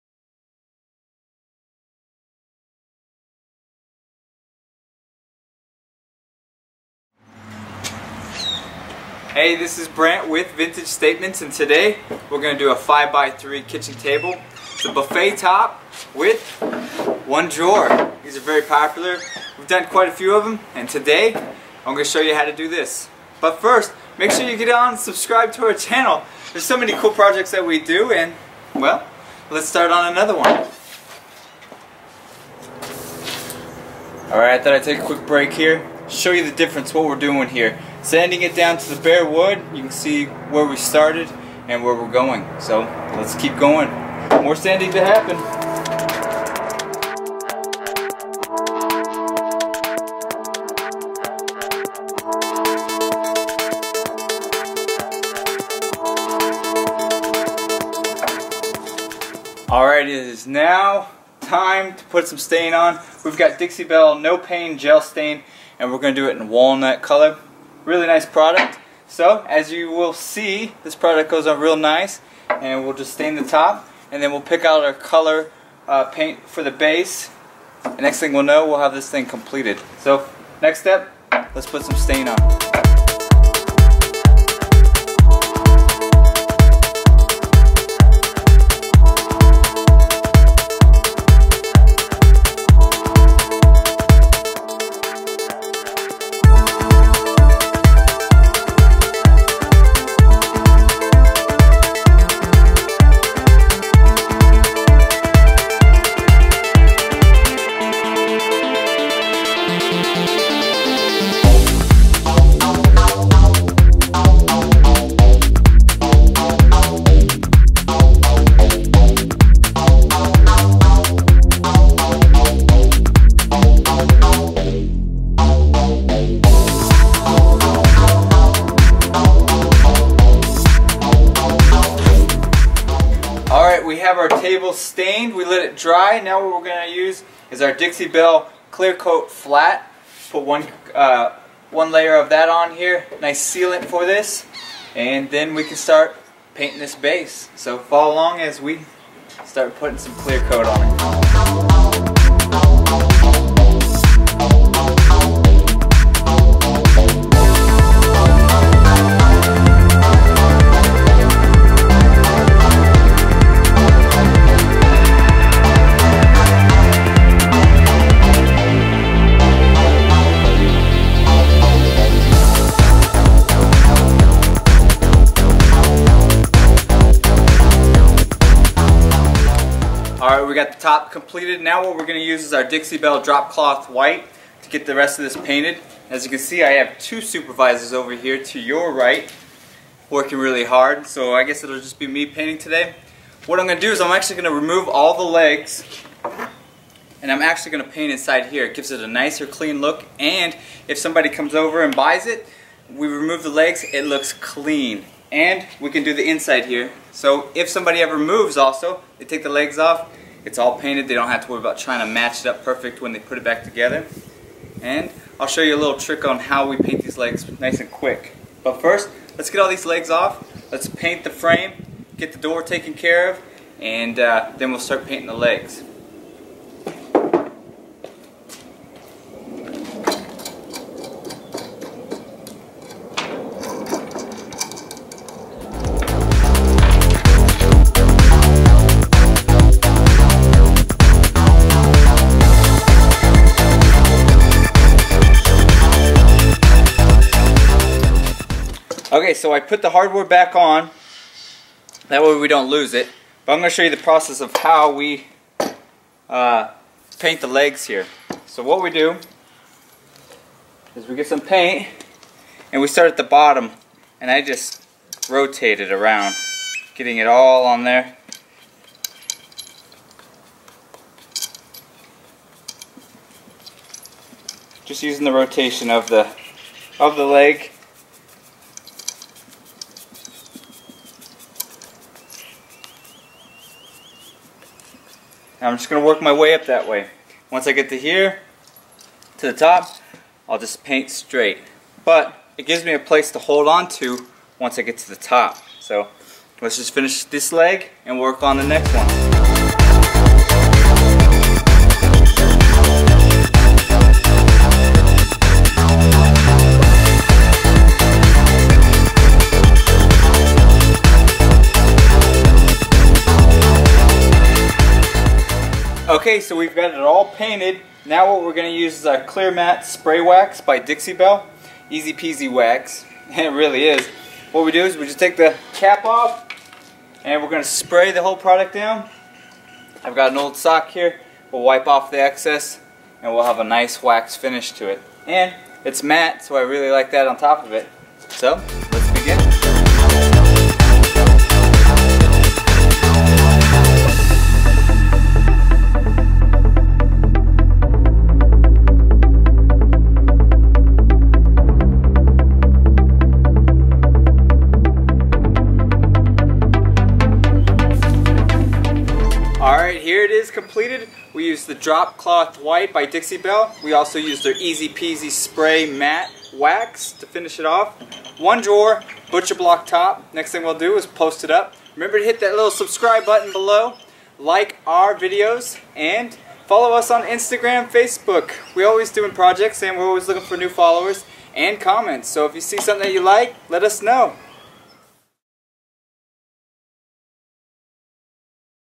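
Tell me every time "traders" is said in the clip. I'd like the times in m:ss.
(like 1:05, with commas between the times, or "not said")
not said.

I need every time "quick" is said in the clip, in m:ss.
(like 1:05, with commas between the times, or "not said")
0:35, 3:37.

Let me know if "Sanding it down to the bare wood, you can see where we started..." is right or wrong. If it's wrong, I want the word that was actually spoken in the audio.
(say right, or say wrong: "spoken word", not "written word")
right.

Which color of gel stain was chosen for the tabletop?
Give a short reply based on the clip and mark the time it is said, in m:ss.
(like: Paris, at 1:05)
Walnut, at 1:06.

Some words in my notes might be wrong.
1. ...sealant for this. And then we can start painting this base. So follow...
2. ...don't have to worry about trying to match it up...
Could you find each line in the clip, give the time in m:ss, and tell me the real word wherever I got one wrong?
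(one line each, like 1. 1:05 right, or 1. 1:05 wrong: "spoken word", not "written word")
1. 2:23 right
2. 3:31 right.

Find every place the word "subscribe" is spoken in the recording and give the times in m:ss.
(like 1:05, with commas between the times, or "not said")
0:24, 6:12.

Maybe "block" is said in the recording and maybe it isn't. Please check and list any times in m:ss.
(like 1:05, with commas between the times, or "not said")
6:09.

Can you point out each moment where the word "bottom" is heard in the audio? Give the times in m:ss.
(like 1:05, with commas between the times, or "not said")
4:23.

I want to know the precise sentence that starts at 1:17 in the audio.
The next thing we'll know, we'll have this thing completed.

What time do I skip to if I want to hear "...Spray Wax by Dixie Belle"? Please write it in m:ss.
5:19.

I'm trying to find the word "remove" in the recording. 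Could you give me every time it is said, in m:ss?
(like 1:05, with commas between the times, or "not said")
3:14, 3:23.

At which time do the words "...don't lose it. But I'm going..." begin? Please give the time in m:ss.
4:12.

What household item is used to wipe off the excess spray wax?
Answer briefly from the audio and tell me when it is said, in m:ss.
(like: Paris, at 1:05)
An old sock, at 5:30.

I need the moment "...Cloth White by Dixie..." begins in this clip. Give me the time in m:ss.
6:02.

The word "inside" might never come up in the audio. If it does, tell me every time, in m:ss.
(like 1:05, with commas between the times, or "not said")
3:18, 3:26.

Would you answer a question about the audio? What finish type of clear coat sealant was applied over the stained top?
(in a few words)
Flat.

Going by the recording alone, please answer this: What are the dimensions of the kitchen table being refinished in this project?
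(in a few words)
5x3.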